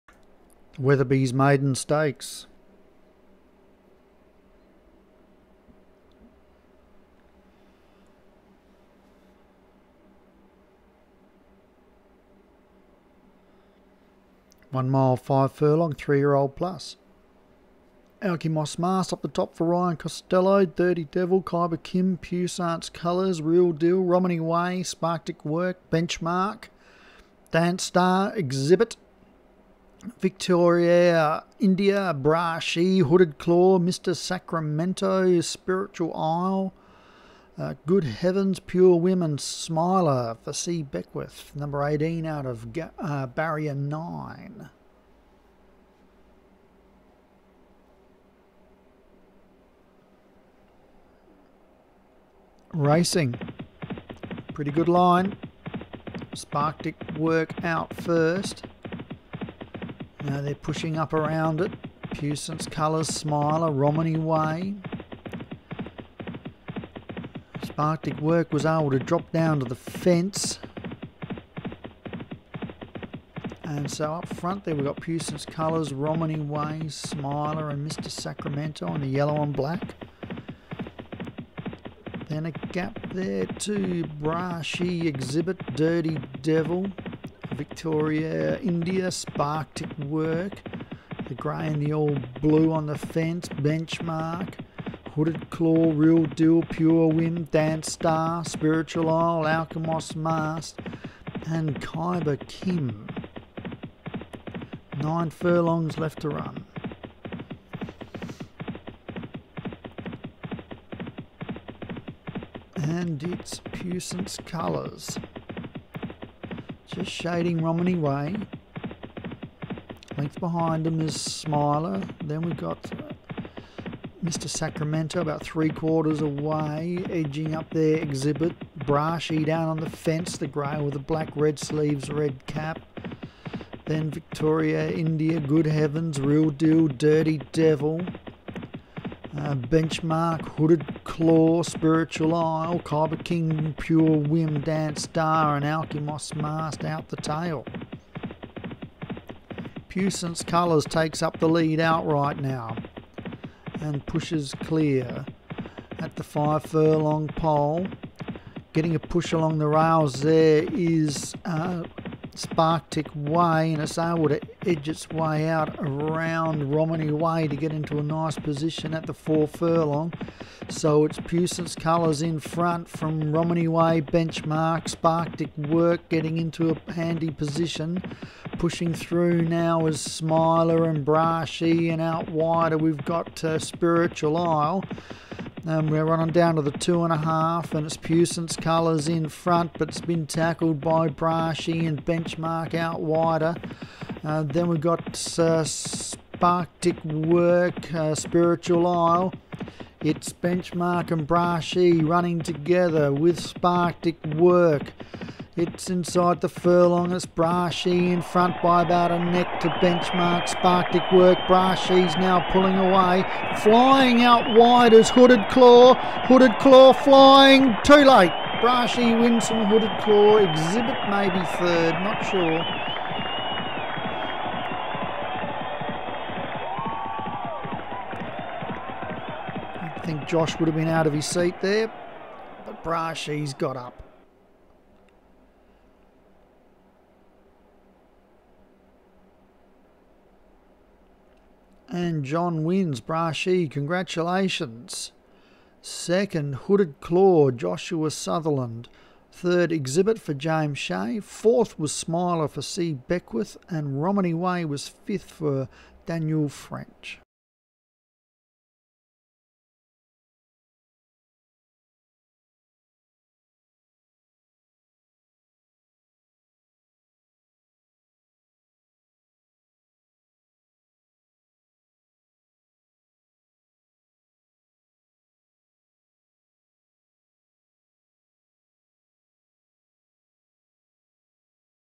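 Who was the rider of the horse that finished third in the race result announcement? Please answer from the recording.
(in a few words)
James Shea.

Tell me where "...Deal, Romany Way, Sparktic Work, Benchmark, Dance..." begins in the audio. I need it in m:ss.
0:23.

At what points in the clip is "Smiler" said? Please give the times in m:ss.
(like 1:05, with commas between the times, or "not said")
0:39, 1:03, 1:16, 2:01, 2:59, 4:11.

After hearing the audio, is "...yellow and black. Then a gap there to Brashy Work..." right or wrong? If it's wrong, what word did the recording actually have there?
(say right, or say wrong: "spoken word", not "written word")
wrong: "Exhibit", not "Work".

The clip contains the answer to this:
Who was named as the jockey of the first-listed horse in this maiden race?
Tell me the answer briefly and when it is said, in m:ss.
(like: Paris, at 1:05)
Ryan Costello, at 0:19.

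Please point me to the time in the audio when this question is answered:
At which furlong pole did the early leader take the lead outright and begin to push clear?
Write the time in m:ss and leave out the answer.
2:36.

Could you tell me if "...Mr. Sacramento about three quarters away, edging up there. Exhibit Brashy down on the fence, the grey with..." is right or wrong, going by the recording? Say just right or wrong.
right.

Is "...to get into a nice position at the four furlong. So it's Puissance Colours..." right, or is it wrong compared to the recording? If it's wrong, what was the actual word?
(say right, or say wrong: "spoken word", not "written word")
right.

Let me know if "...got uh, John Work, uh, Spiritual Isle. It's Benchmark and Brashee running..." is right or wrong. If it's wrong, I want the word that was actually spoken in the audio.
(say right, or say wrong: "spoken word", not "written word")
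wrong: "Sparktic", not "John".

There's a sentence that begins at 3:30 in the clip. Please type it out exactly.
Sparktic Work, Brashee's now pulling away.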